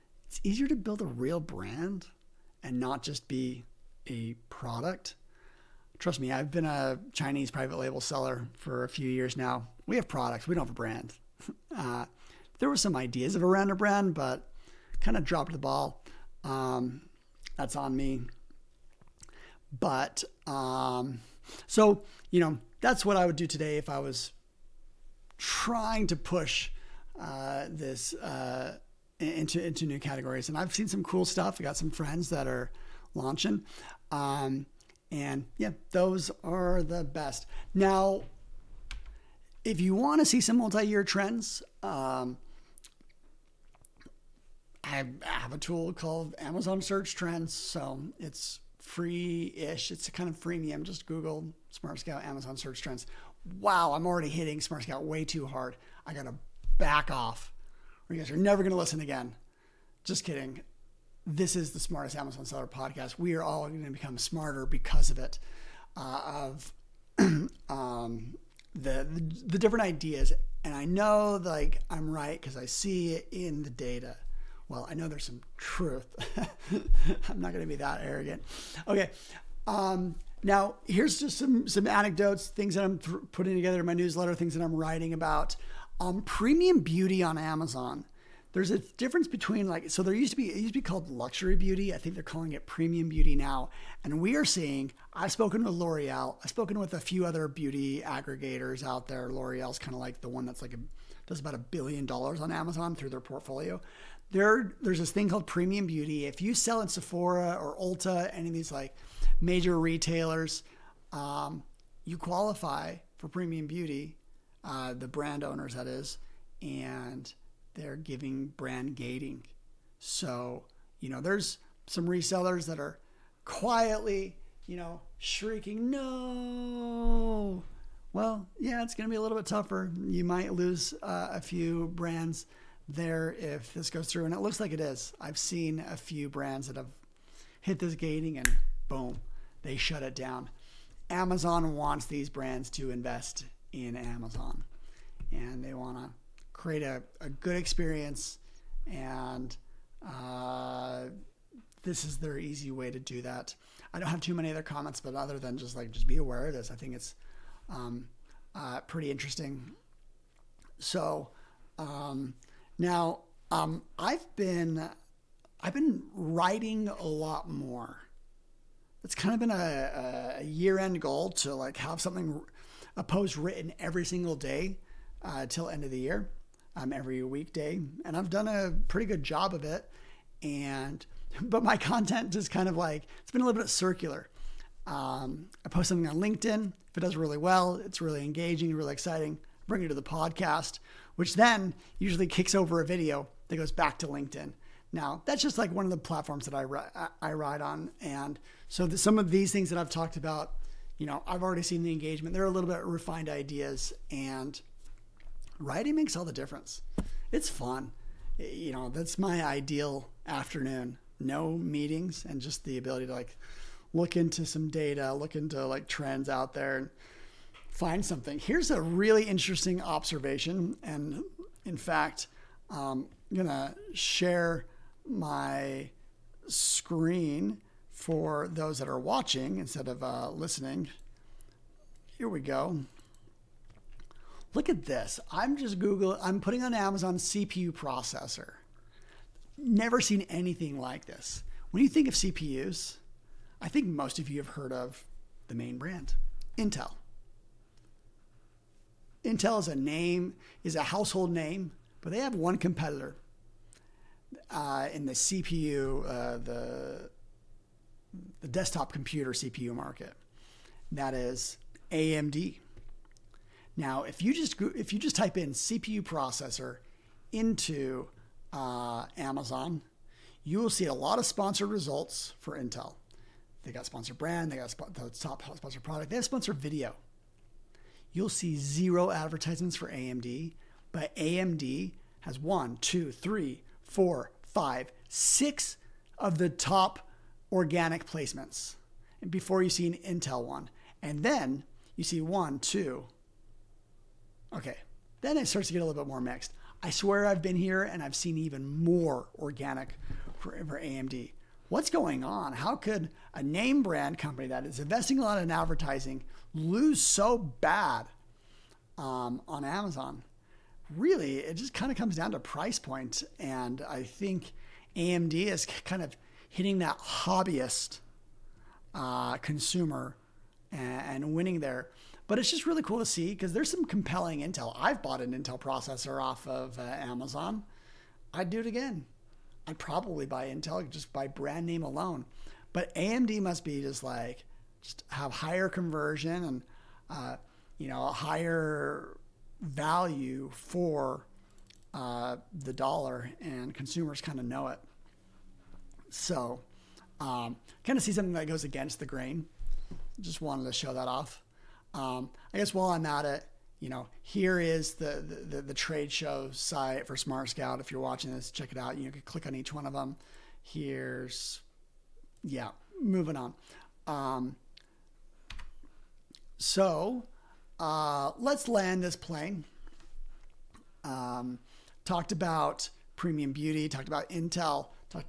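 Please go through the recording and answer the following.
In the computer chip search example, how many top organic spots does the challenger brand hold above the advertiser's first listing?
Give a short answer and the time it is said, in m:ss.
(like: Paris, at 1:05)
6, at 4:45.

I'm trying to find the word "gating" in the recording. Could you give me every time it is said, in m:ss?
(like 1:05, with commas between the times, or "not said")
1:58, 2:17.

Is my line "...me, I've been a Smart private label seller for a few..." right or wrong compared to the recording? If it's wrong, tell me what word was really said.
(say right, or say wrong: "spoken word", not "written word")
wrong: "Chinese", not "Smart".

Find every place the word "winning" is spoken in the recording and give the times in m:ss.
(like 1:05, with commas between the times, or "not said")
5:21.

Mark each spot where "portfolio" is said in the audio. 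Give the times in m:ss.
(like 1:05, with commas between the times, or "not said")
1:43.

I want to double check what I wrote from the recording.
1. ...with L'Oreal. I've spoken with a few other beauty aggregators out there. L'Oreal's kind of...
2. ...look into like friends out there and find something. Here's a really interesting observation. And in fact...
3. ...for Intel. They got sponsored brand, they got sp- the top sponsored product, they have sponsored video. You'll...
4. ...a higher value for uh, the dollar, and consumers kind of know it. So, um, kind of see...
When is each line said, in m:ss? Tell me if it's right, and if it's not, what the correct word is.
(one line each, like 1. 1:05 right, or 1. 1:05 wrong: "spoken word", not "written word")
1. 1:35 right
2. 3:35 wrong: "trends", not "friends"
3. 4:32 right
4. 5:38 right.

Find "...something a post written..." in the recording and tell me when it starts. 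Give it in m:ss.
2:52.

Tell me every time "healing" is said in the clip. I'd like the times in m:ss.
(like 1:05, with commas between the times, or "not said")
not said.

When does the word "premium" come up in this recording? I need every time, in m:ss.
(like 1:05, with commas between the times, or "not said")
1:26, 1:32, 1:45, 1:53, 6:13.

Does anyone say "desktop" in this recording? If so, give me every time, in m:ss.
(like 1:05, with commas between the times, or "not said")
4:18.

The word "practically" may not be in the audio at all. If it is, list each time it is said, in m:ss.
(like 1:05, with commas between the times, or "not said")
not said.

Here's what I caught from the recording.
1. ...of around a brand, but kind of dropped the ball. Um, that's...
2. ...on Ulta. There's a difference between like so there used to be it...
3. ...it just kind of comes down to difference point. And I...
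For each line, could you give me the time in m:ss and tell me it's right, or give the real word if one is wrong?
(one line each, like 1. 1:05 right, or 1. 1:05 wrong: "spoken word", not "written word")
1. 0:13 right
2. 1:27 wrong: "Amazon", not "Ulta"
3. 5:11 wrong: "price", not "difference".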